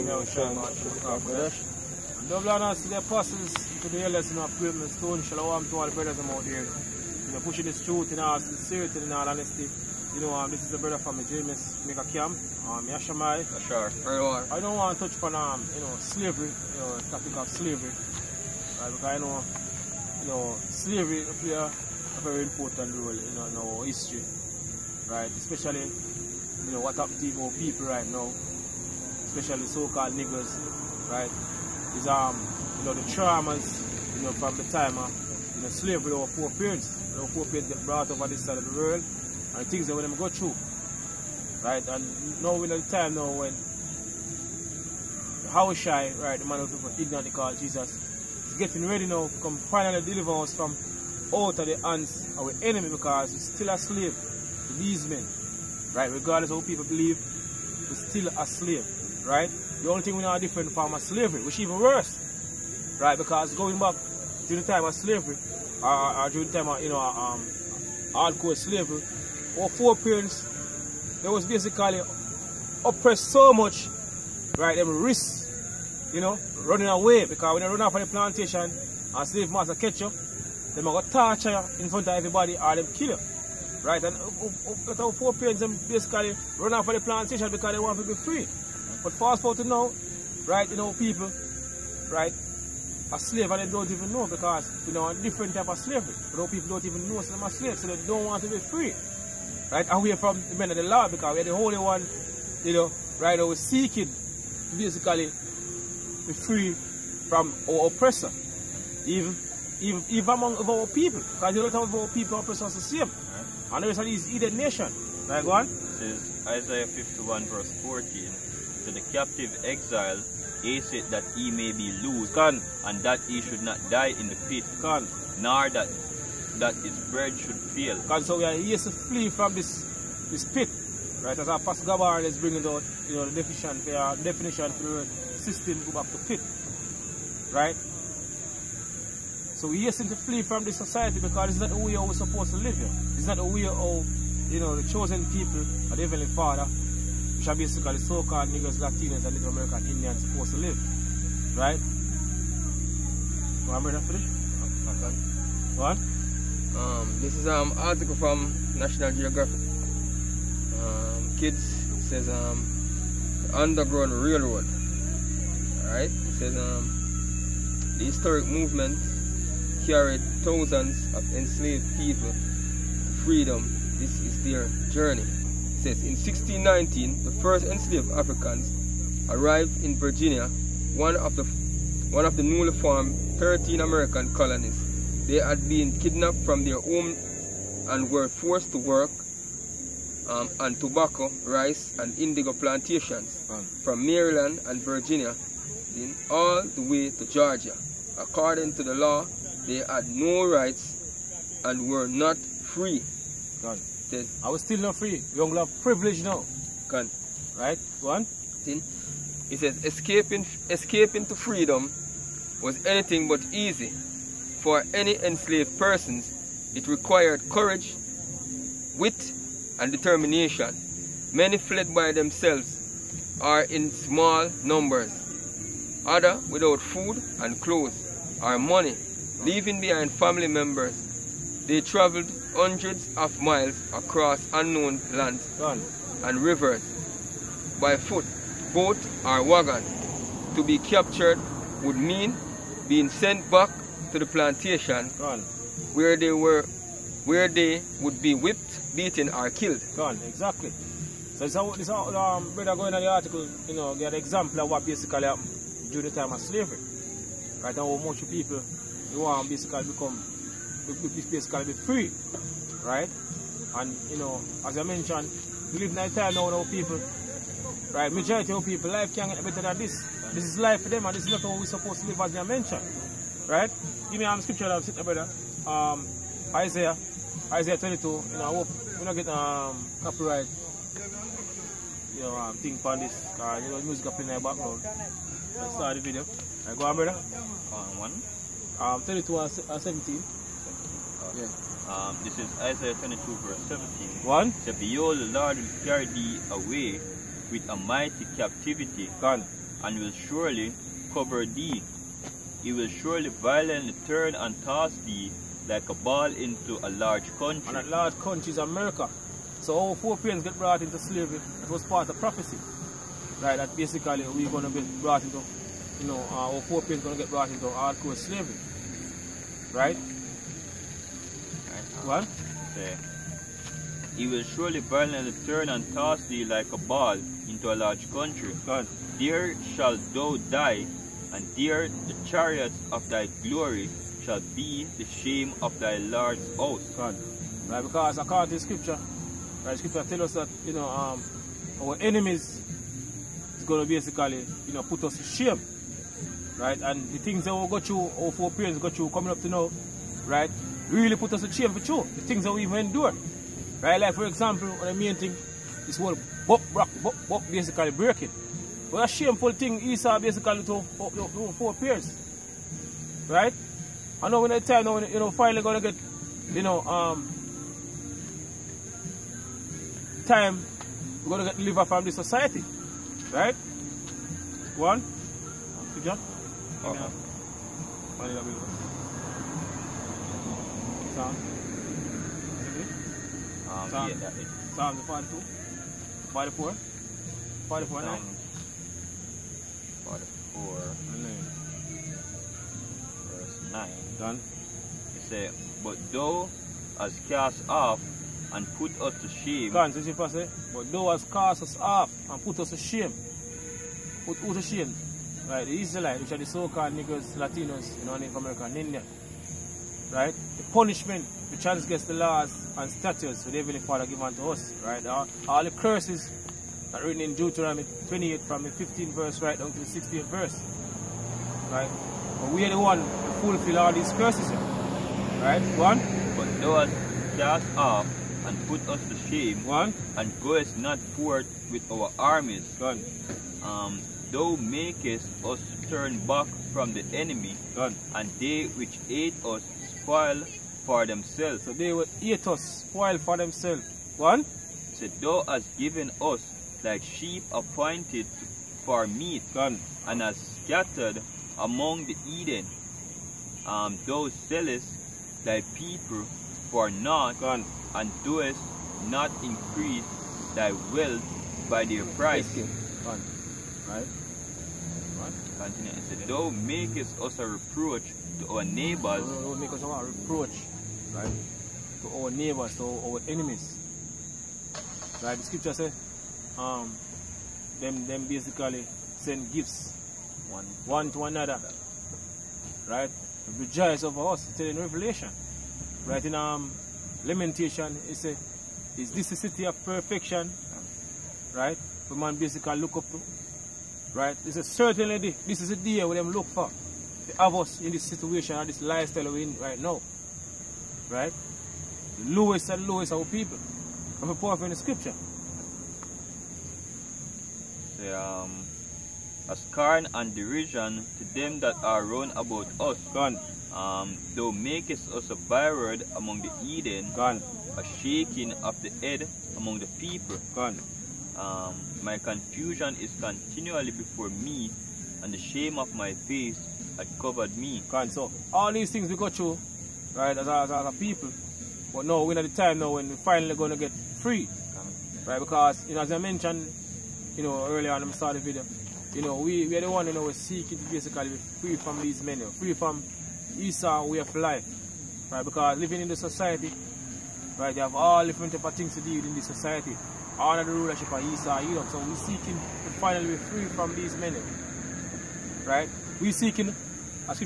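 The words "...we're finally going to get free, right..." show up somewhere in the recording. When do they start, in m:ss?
8:53.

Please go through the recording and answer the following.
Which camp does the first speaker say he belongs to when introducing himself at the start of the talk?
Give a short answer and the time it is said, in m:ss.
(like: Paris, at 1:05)
James Mega Camp, at 0:11.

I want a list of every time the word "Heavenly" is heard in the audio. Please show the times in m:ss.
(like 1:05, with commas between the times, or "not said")
2:26, 6:53.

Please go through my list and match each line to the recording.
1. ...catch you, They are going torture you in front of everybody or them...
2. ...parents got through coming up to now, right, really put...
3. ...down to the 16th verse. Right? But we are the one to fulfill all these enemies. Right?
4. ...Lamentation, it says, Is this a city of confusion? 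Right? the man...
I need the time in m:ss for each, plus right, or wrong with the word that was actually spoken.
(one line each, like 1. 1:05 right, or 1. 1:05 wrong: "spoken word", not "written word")
1. 1:19 right
2. 5:48 right
3. 6:59 wrong: "curses", not "enemies"
4. 8:07 wrong: "perfection", not "confusion".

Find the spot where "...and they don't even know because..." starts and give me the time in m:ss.
1:33.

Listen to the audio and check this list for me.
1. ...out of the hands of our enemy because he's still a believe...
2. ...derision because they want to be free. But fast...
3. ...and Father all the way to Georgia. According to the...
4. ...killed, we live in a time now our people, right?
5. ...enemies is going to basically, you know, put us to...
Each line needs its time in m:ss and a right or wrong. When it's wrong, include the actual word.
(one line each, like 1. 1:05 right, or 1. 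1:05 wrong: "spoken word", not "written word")
1. 0:51 wrong: "slave", not "believe"
2. 1:27 wrong: "plantation", not "derision"
3. 3:14 wrong: "Virginia", not "Father"
4. 4:24 wrong: "mentioned", not "killed"
5. 5:42 right.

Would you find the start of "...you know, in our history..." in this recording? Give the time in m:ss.
0:23.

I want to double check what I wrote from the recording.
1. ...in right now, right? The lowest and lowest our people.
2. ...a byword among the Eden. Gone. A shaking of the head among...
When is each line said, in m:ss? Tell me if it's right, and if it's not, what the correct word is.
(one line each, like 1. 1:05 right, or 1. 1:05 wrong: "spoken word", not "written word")
1. 8:19 right
2. 8:35 right.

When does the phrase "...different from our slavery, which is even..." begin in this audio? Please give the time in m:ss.
1:00.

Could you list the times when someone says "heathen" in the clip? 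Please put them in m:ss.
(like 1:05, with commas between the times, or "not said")
1:54.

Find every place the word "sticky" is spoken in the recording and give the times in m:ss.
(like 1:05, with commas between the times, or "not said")
not said.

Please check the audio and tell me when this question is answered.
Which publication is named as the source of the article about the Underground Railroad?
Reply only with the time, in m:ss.
2:38.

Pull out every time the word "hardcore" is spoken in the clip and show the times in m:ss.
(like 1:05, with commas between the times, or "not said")
1:08, 5:17.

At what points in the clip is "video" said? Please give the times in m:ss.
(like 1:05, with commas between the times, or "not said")
4:46, 8:58.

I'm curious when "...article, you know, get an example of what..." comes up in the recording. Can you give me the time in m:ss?
4:13.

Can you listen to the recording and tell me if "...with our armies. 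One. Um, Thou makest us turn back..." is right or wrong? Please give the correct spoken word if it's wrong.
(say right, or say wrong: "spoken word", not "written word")
right.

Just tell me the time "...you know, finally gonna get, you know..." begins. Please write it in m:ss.
6:05.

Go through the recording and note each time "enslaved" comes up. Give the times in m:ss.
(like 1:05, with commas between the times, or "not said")
2:51, 2:57, 3:35.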